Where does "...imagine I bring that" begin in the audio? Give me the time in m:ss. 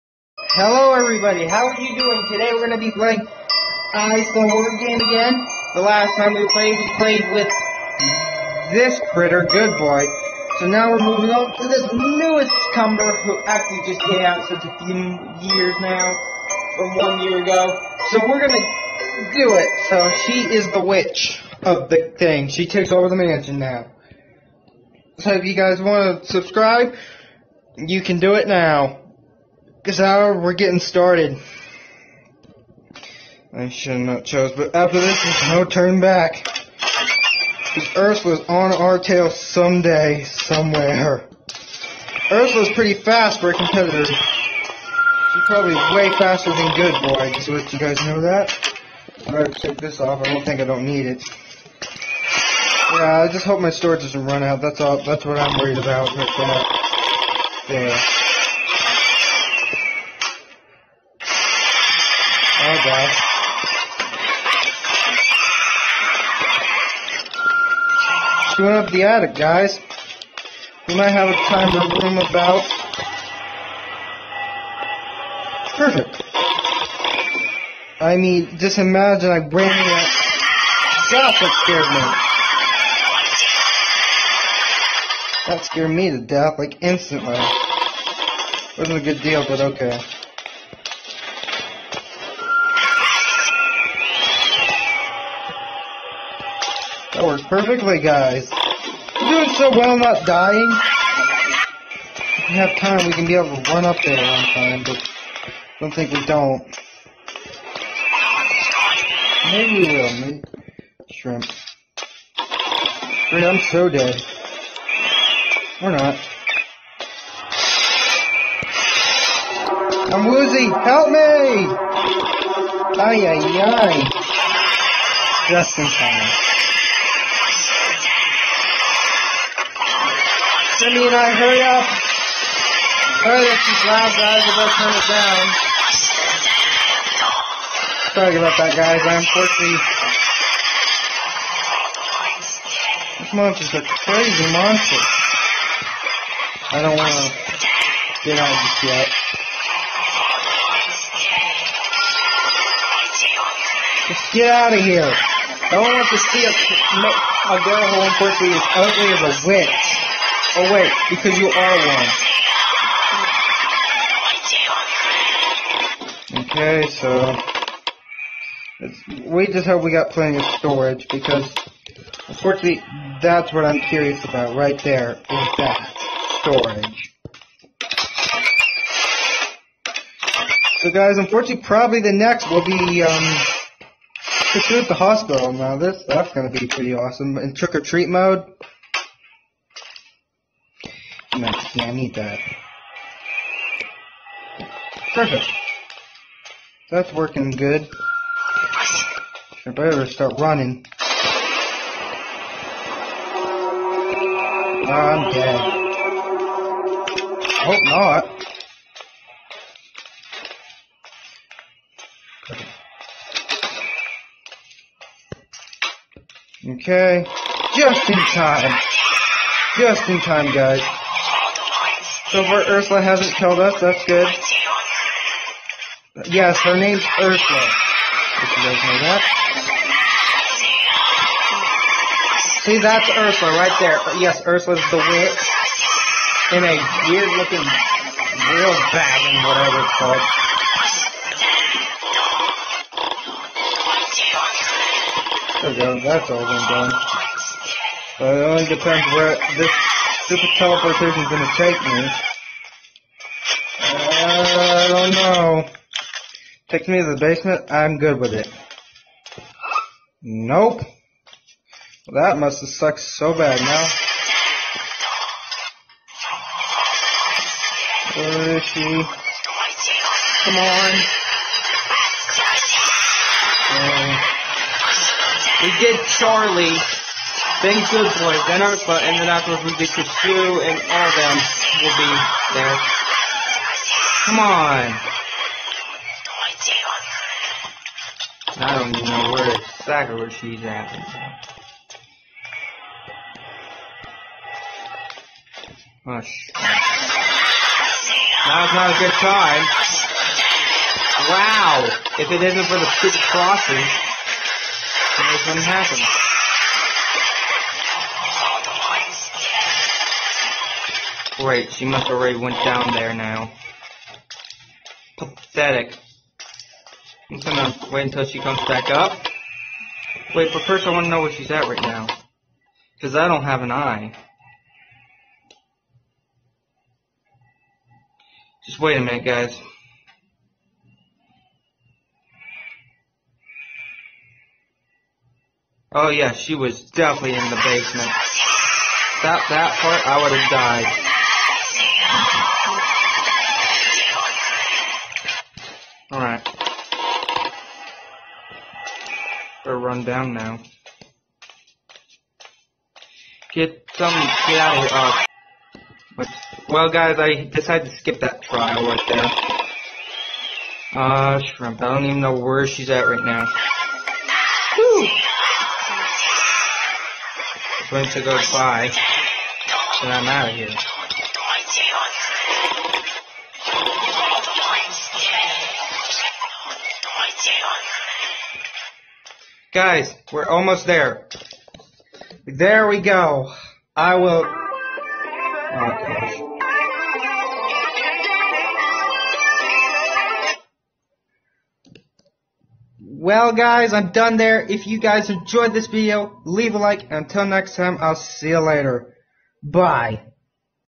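1:18.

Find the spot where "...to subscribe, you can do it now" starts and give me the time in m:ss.
0:26.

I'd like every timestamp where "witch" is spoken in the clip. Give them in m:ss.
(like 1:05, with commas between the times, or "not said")
0:20, 2:39, 3:54.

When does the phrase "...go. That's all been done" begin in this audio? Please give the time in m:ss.
4:05.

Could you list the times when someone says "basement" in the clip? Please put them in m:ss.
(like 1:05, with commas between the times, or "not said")
4:17, 5:37.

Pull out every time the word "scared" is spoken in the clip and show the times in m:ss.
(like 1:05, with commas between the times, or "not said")
1:21, 1:25.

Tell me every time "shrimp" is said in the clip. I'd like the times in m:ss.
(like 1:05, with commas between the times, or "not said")
1:51, 6:01.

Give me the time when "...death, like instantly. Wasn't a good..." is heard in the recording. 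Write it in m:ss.
1:26.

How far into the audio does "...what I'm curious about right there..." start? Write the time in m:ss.
2:53.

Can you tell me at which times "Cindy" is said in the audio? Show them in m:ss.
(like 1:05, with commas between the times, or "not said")
2:10.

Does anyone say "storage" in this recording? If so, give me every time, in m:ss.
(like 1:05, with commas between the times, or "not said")
0:53, 2:50, 2:56.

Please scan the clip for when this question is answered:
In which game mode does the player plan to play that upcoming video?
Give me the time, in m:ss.
3:07.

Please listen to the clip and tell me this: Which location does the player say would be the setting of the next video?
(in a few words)
the hospital.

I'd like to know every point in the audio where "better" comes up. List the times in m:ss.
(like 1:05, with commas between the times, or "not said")
2:14, 3:19, 5:49.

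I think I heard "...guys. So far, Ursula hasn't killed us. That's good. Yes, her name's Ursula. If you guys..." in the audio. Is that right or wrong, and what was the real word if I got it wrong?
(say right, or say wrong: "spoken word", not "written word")
right.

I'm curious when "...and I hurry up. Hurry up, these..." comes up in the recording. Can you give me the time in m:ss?
2:11.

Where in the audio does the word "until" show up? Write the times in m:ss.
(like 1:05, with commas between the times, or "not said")
5:18, 6:37.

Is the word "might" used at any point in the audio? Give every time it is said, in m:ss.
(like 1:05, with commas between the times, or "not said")
1:10.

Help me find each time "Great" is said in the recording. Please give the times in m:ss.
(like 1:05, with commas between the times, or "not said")
5:11.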